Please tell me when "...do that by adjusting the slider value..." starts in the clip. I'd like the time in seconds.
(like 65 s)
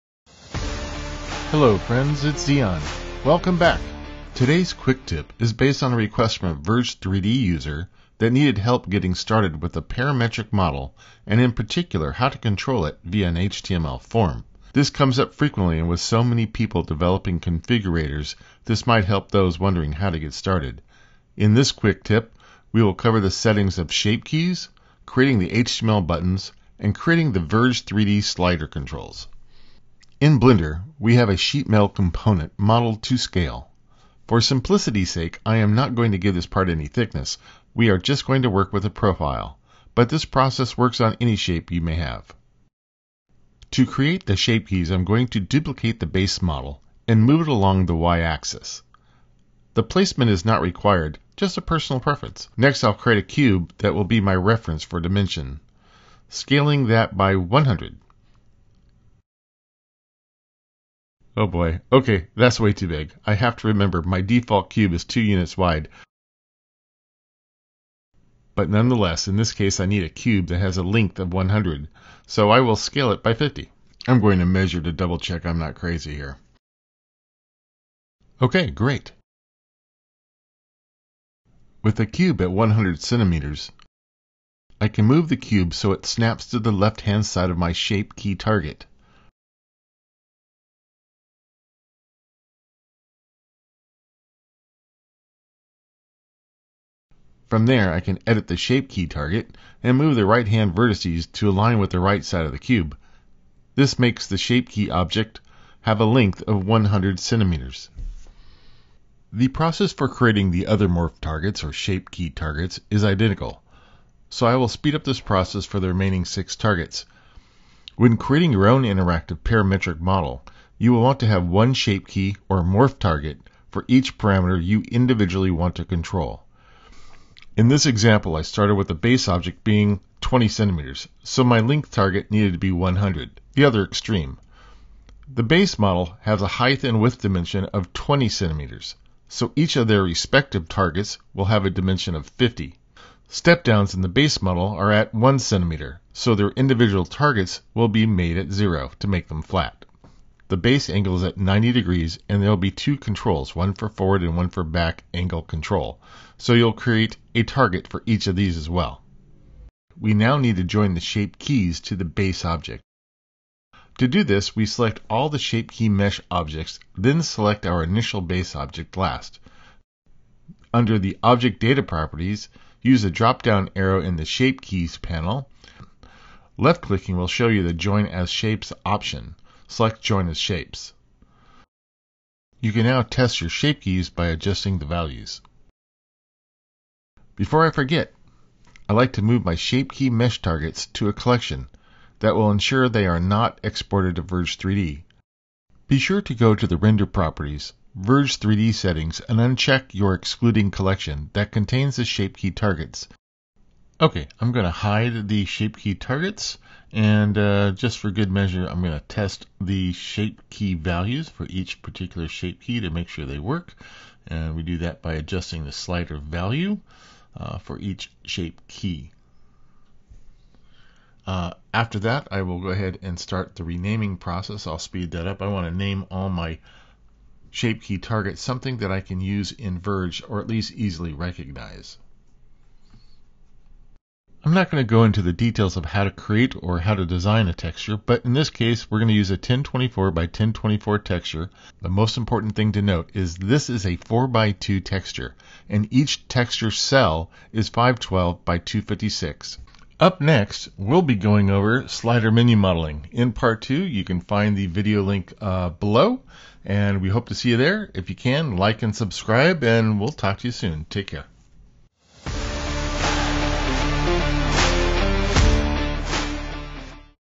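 214 s.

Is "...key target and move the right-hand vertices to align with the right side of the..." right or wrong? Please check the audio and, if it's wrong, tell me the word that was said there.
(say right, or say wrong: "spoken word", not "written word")
right.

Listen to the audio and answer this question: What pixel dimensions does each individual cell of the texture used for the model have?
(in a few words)
512 by 256.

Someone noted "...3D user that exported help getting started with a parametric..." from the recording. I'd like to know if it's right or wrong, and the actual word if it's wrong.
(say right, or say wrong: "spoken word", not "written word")
wrong: "needed", not "exported".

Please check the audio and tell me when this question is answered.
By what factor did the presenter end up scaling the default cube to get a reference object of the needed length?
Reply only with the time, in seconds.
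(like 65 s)
72 s.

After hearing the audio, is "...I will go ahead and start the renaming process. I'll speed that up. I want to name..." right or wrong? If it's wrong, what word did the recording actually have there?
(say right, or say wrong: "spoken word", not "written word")
right.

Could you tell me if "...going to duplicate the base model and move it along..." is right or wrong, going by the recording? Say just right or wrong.
right.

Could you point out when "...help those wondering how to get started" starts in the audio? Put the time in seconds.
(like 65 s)
19 s.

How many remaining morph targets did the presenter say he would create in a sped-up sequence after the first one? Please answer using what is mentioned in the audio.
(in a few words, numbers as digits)
6.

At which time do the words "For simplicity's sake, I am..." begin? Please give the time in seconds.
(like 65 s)
34 s.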